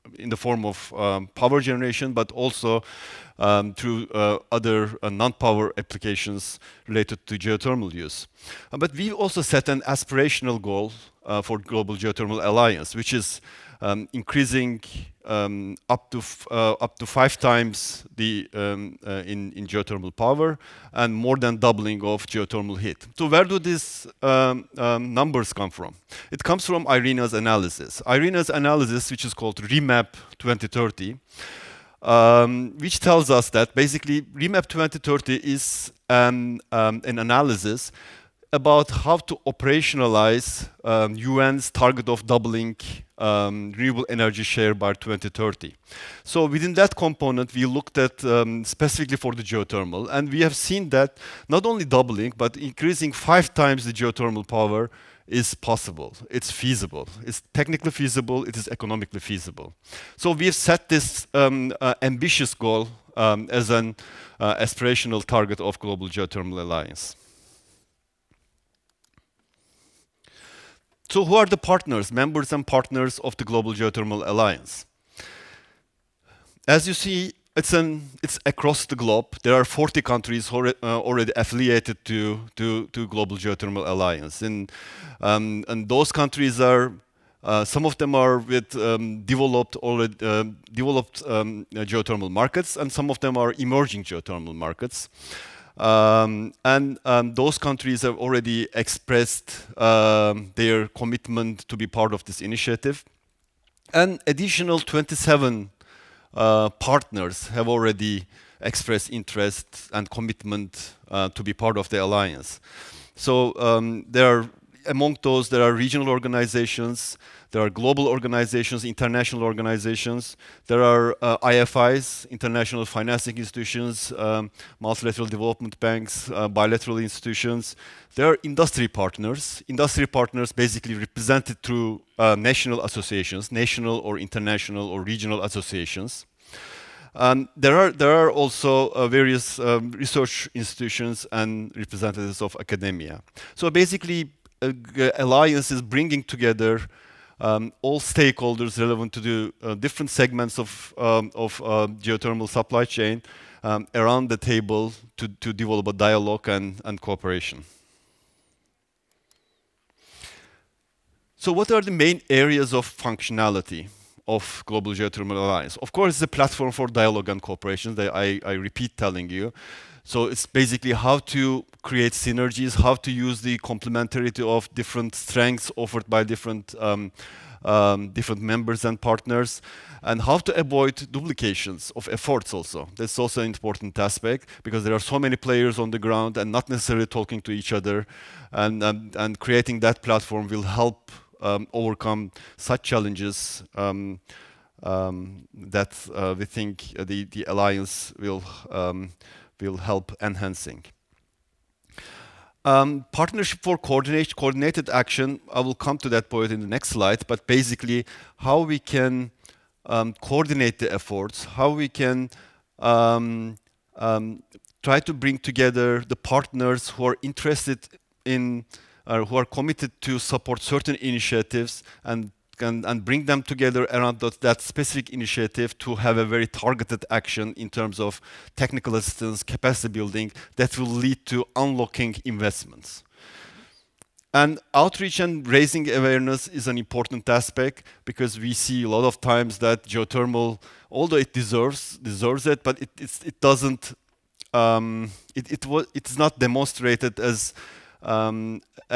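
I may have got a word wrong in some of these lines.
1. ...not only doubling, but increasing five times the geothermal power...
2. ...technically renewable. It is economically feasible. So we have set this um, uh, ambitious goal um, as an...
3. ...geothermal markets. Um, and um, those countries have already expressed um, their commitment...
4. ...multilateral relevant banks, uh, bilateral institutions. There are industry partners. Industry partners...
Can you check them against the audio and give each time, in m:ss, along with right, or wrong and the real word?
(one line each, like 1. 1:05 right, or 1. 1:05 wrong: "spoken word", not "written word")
1. 0:51 right
2. 0:57 wrong: "feasible", not "renewable"
3. 1:34 right
4. 2:04 wrong: "development", not "relevant".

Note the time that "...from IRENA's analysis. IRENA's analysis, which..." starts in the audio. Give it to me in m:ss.
0:26.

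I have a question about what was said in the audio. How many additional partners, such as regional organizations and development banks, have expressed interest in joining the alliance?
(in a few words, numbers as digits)
27.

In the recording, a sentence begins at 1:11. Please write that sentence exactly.
So who are the partners, members and partners of the Global Geothermal Alliance?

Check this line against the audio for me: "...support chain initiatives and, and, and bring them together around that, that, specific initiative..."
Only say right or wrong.
wrong.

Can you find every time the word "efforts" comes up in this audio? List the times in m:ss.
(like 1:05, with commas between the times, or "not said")
3:02, 3:30.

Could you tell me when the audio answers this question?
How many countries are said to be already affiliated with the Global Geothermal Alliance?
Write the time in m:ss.
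1:19.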